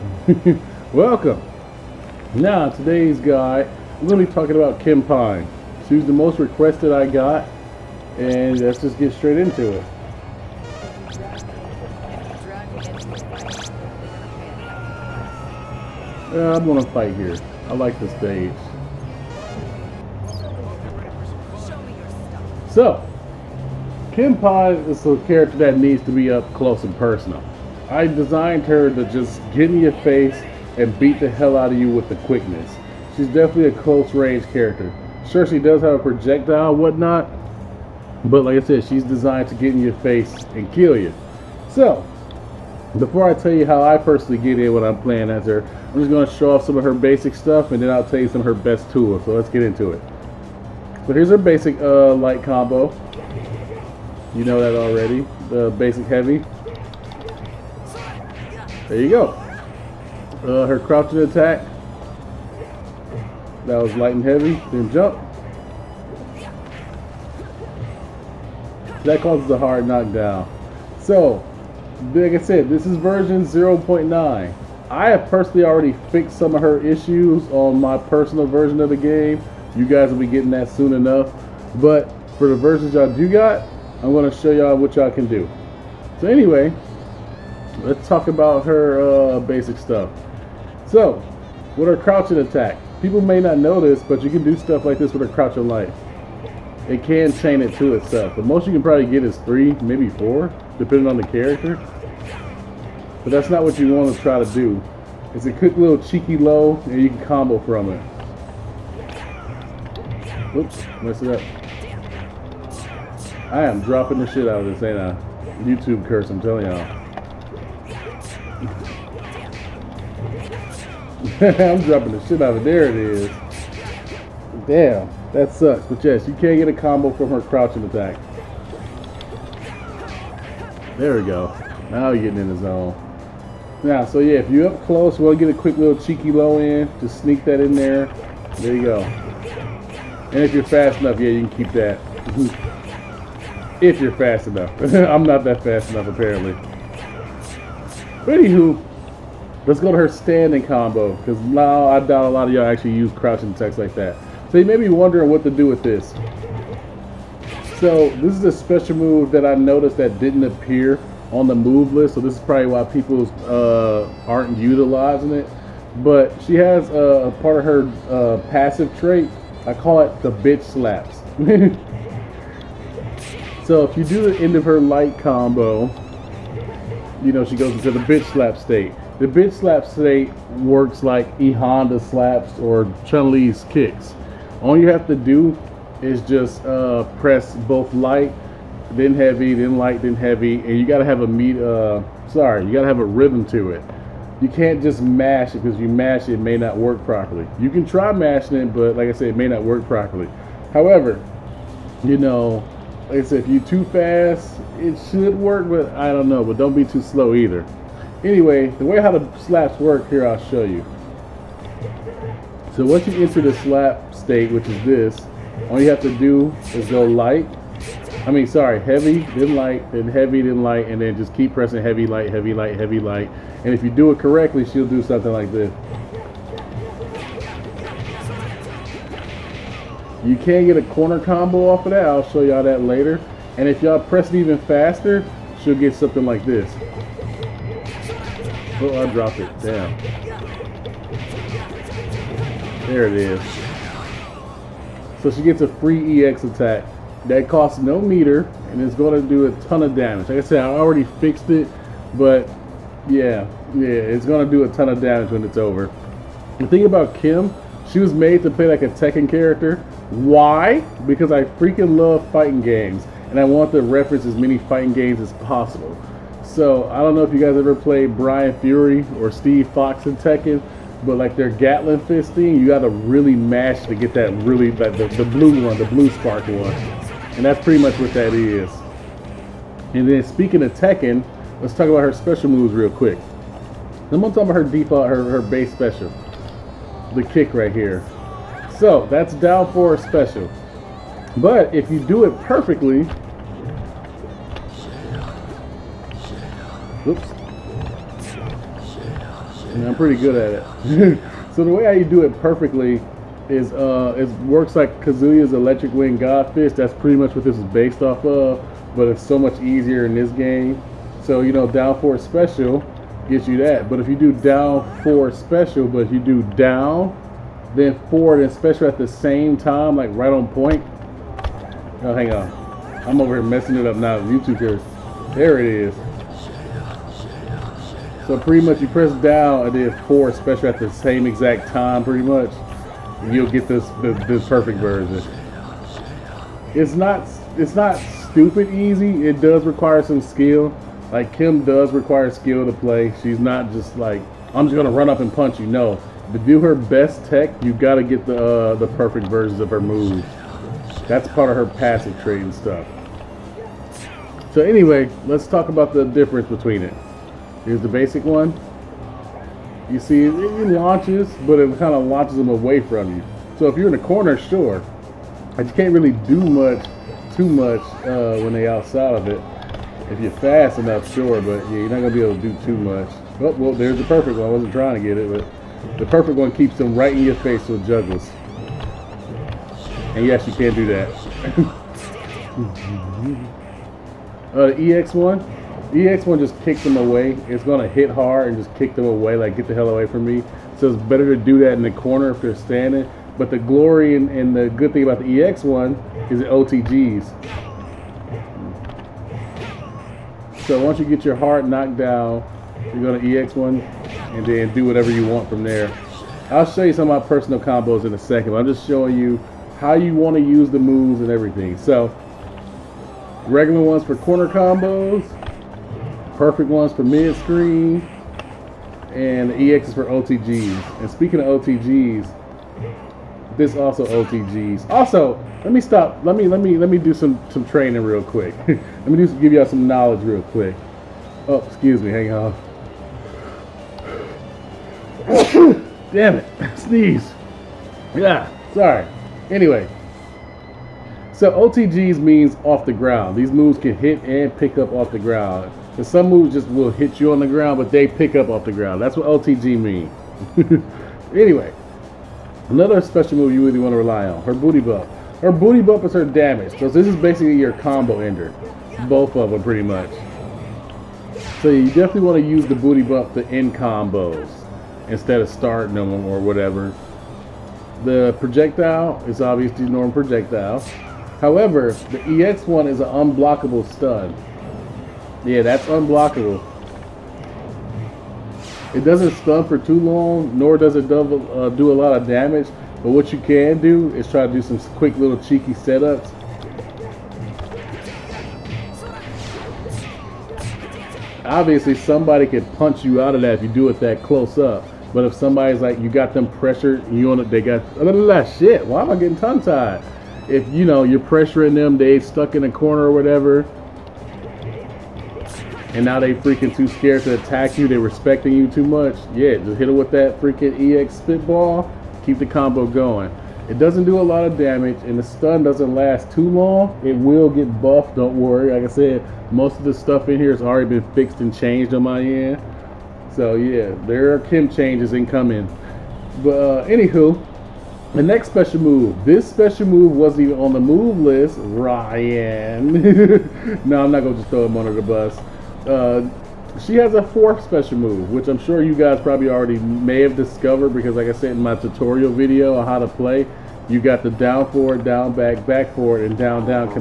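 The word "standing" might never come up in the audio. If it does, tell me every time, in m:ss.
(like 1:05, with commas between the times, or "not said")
2:30, 6:32.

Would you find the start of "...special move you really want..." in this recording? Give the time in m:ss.
7:33.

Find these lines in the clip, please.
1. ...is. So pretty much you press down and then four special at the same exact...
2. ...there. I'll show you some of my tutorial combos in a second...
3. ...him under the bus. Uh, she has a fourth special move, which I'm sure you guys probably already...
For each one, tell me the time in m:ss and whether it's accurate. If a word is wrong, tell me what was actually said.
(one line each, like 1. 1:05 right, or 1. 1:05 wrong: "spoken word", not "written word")
1. 5:25 right
2. 6:45 wrong: "personal", not "tutorial"
3. 8:54 right.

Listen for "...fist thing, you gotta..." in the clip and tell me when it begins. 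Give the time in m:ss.
4:32.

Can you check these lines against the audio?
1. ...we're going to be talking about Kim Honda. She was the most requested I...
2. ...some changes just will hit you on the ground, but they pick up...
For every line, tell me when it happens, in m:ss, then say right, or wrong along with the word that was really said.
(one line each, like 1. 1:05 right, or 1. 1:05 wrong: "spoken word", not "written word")
1. 0:04 wrong: "Pine", not "Honda"
2. 7:26 wrong: "moves", not "changes".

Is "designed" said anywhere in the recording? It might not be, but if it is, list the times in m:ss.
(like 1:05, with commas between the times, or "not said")
0:28, 0:39.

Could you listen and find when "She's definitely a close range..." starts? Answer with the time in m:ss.
0:33.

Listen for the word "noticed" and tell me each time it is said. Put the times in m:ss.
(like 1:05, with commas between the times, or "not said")
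2:39.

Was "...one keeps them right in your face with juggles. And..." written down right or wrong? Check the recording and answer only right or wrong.
right.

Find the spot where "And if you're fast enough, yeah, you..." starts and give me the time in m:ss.
2:20.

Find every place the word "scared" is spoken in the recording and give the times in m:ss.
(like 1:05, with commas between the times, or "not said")
8:26.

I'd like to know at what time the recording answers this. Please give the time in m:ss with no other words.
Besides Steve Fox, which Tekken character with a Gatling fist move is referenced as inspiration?
4:28.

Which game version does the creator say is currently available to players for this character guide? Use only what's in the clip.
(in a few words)
0.9.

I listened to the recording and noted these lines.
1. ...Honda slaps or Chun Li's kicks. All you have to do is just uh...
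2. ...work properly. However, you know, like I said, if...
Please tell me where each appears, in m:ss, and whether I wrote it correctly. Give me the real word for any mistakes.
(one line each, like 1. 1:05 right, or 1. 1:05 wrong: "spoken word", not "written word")
1. 3:01 right
2. 3:19 right.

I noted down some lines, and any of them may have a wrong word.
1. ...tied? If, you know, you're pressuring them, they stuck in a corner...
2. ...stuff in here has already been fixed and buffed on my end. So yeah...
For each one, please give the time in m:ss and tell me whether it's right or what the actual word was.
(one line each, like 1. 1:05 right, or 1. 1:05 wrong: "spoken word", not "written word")
1. 8:19 right
2. 8:39 wrong: "changed", not "buffed".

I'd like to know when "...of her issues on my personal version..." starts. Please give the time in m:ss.
1:16.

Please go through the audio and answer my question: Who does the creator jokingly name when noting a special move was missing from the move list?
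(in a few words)
Ryon.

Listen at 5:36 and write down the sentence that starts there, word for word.
It's not it's not stupid easy.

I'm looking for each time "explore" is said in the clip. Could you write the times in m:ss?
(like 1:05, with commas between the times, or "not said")
not said.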